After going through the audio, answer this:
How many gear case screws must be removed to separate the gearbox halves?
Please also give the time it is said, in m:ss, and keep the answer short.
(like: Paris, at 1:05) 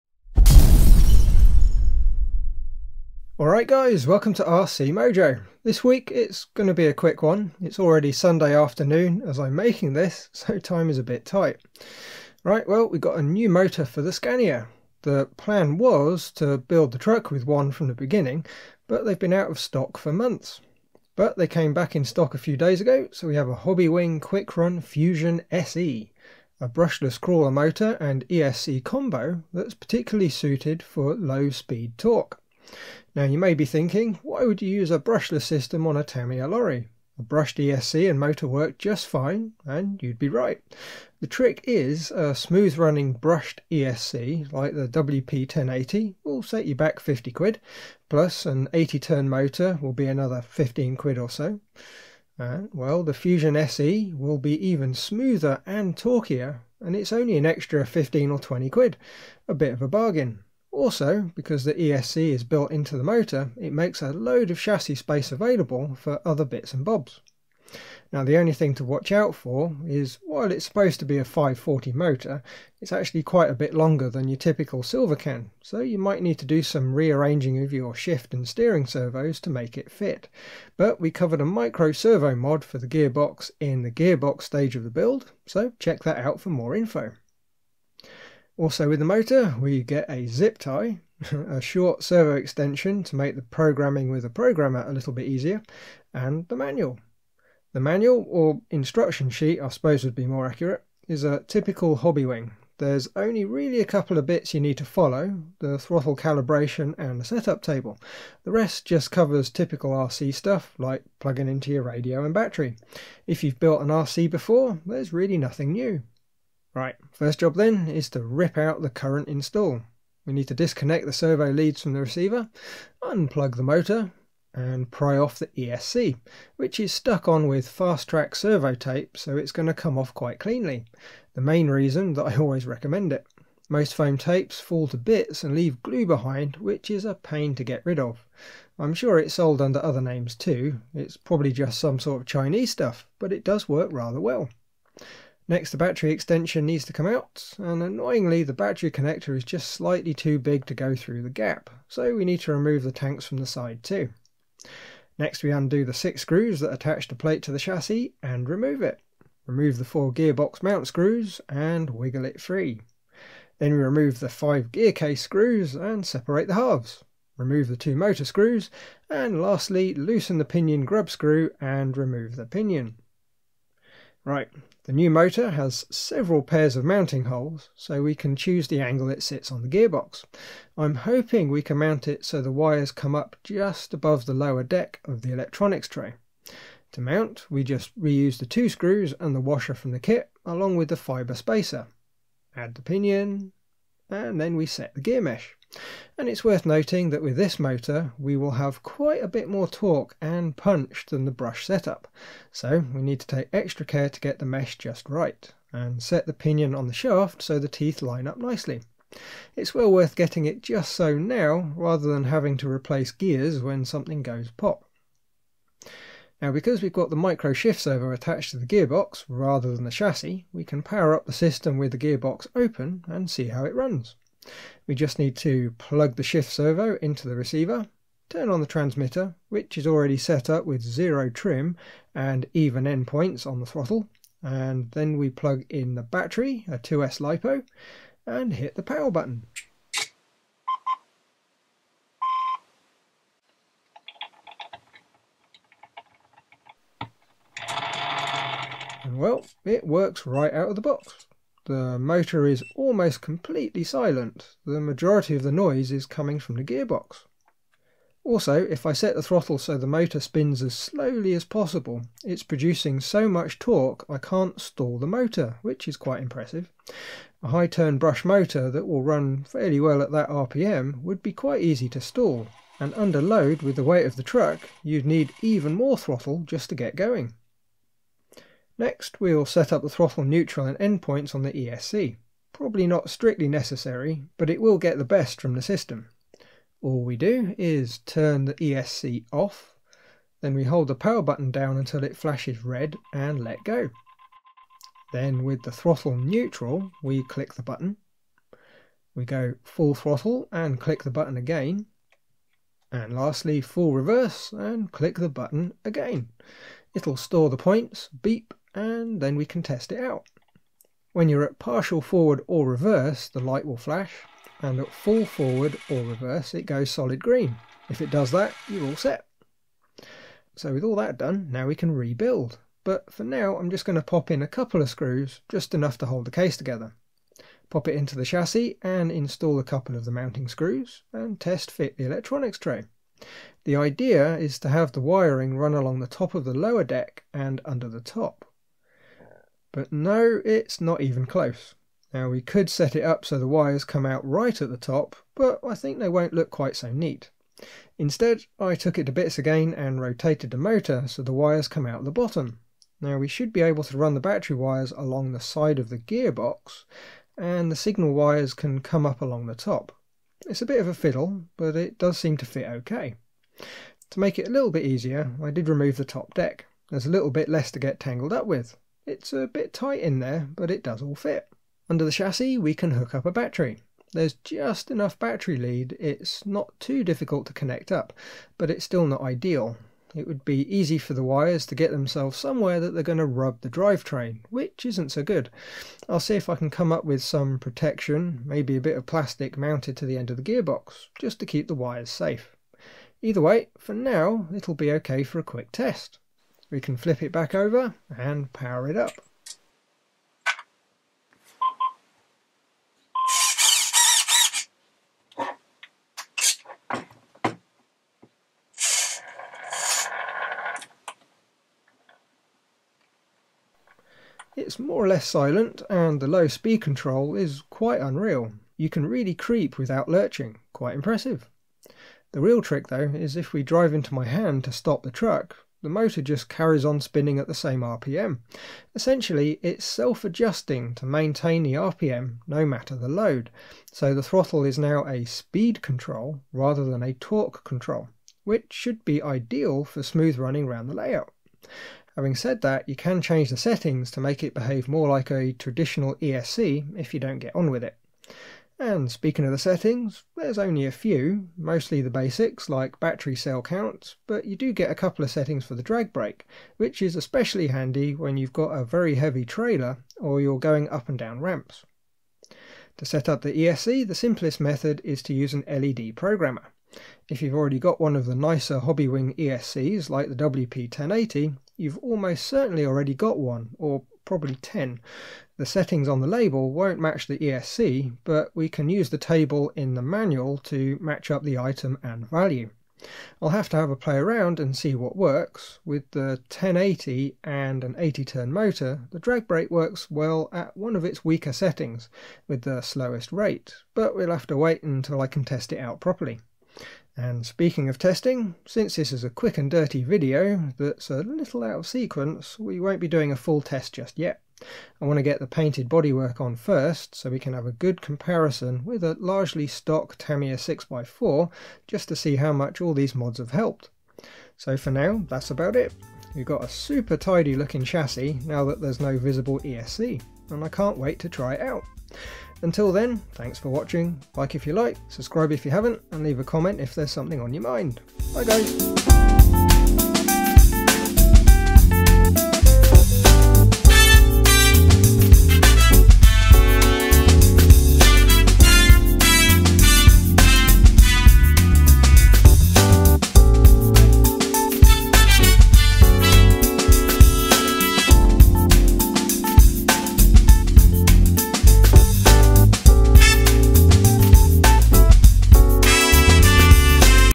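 5, at 2:44.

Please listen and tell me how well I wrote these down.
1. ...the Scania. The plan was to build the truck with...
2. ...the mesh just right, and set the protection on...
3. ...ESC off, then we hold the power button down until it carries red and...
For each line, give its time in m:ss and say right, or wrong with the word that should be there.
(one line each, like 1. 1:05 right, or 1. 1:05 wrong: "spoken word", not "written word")
1. 0:14 right
2. 3:24 wrong: "pinion", not "protection"
3. 4:48 wrong: "flashes", not "carries".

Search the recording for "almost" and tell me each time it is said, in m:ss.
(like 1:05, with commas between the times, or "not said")
4:12, 7:51.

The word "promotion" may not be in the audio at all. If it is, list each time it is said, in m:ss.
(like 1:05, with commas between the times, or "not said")
not said.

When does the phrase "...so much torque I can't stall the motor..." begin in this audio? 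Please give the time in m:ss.
4:23.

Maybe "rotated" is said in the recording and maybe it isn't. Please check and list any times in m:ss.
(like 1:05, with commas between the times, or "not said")
5:50.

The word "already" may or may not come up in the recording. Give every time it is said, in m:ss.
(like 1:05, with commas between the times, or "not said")
0:07, 3:49, 7:47, 7:52.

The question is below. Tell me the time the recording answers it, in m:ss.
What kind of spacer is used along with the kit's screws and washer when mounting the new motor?
3:10.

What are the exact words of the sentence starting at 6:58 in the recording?
You can really creep without lurching, quite impressive.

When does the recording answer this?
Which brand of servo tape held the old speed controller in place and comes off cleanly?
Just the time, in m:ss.
2:07.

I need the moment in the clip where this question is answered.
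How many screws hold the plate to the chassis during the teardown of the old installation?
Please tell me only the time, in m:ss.
2:35.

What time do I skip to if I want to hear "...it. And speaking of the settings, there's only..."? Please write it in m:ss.
7:27.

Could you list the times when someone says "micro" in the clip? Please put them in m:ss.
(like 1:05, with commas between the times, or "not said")
1:21, 3:37.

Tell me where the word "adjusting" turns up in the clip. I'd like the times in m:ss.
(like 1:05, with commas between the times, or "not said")
7:10.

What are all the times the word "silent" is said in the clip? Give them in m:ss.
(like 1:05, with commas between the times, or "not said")
4:13, 6:55.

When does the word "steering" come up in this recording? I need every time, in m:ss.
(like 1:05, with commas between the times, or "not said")
1:18.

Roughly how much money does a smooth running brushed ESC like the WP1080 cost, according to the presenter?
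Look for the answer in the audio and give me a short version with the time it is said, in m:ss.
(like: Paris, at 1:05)
50 quid, at 0:46.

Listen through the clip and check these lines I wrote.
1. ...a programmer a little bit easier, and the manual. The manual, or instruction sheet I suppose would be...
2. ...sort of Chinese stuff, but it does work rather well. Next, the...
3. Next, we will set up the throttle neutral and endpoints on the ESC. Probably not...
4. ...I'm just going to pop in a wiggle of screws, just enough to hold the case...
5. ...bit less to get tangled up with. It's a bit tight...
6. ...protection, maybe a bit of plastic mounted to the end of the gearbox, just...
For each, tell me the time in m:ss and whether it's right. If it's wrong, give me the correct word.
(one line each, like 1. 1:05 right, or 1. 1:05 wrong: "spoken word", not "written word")
1. 1:34 right
2. 2:21 right
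3. 4:38 right
4. 5:23 wrong: "couple", not "wiggle"
5. 6:07 right
6. 6:27 right.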